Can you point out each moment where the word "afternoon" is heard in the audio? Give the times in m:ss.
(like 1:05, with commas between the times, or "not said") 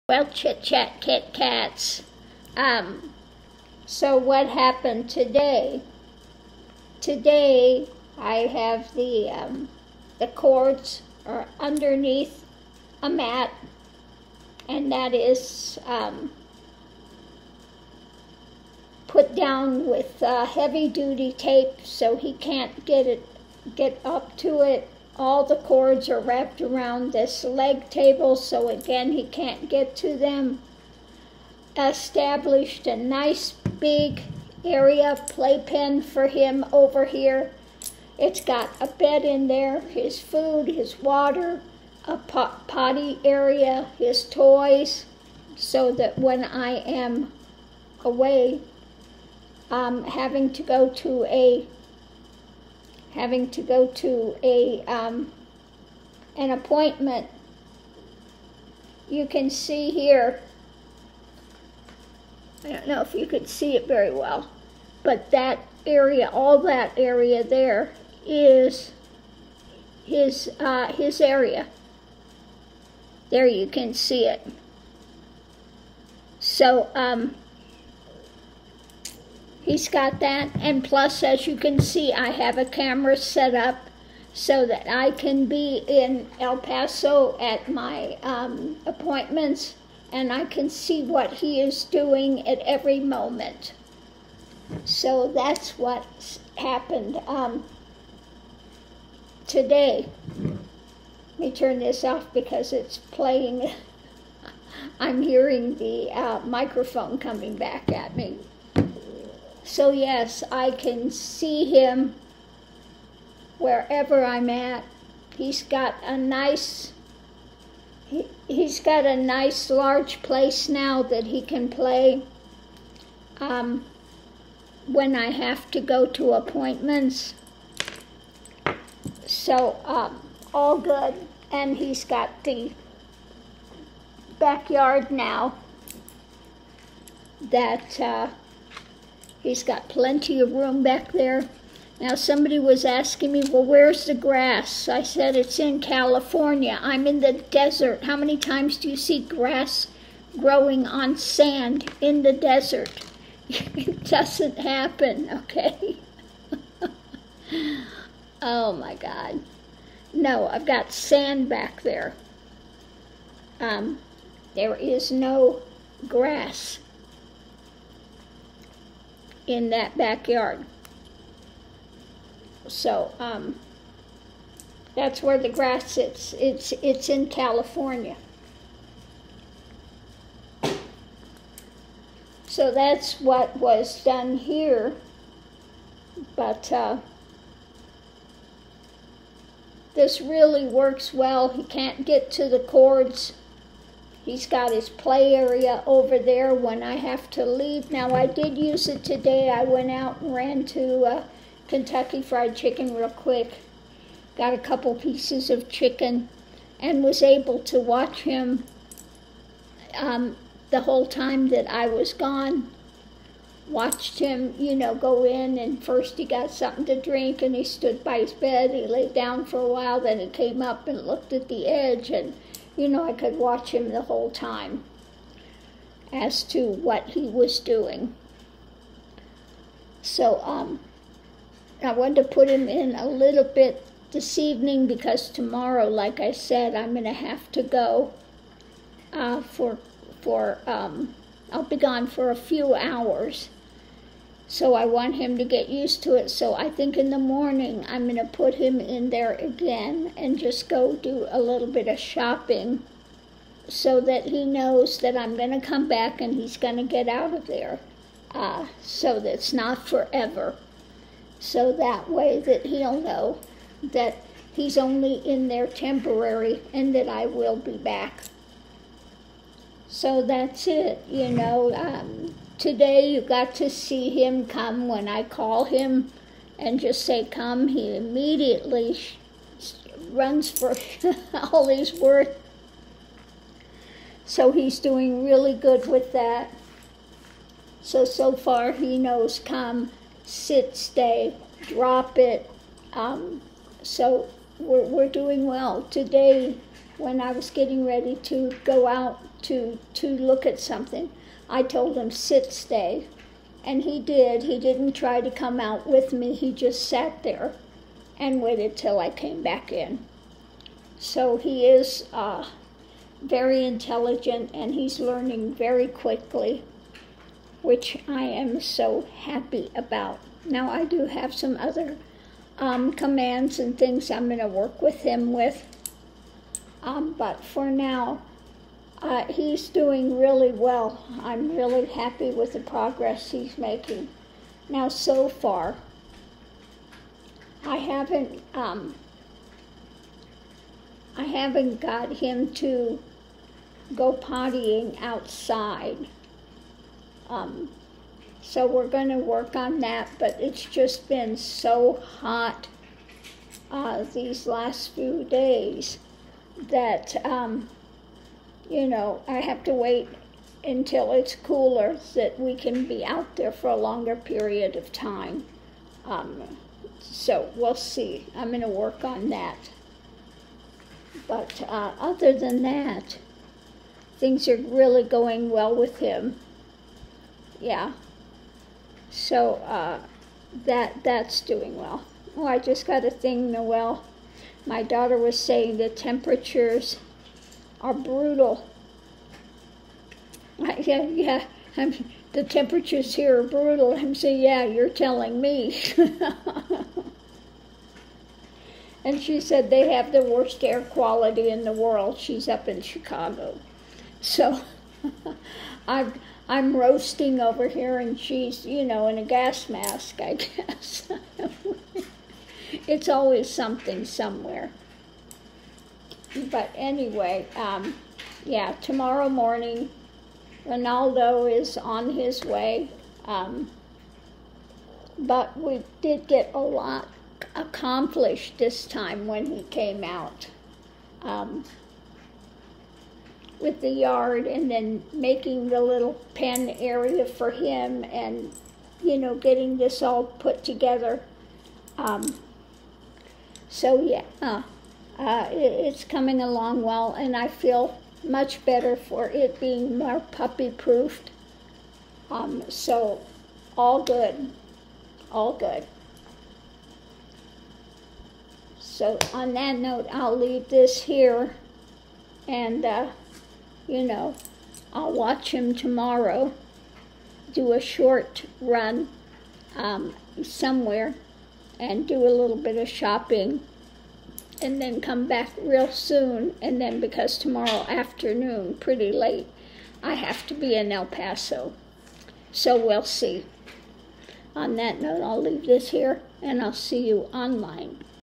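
7:57.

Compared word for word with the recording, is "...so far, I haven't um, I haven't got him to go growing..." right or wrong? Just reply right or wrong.
wrong.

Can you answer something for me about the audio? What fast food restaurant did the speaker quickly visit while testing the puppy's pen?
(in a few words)
Kentucky Fried Chicken.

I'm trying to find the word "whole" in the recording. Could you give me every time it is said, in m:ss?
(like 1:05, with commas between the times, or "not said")
3:30, 3:44.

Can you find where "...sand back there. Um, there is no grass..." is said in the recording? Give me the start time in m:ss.
2:40.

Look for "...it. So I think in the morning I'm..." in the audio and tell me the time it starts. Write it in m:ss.
4:06.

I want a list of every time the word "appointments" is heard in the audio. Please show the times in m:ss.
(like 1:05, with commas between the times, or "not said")
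0:56, 1:28, 2:06.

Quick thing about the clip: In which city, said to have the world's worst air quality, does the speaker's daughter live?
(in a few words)
Chicago.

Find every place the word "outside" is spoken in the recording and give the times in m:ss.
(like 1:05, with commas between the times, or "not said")
5:45.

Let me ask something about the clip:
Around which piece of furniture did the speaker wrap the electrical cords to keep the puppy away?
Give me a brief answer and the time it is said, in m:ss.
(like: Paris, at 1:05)
leg table, at 0:27.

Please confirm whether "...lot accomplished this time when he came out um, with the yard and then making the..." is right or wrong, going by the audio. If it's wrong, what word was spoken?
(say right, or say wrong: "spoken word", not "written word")
right.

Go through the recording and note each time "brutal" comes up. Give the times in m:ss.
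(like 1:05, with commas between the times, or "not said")
6:27, 6:33.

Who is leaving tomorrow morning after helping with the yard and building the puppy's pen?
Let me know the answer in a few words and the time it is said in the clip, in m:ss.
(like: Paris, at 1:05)
Ronaldo, at 7:00.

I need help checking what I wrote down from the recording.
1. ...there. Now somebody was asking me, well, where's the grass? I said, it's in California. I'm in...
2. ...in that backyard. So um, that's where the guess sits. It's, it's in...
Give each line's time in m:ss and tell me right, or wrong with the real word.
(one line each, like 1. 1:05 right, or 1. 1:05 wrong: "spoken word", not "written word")
1. 2:21 right
2. 2:49 wrong: "grass", not "guess".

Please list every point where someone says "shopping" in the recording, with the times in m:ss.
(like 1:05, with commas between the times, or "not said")
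4:11, 7:52.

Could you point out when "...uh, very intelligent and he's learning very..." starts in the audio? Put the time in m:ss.
5:12.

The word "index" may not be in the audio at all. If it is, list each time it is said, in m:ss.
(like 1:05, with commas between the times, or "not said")
not said.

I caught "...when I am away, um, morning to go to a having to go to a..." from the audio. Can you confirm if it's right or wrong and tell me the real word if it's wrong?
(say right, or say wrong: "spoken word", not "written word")
wrong: "having", not "morning".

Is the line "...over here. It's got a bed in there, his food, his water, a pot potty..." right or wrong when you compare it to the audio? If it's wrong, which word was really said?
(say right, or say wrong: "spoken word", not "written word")
right.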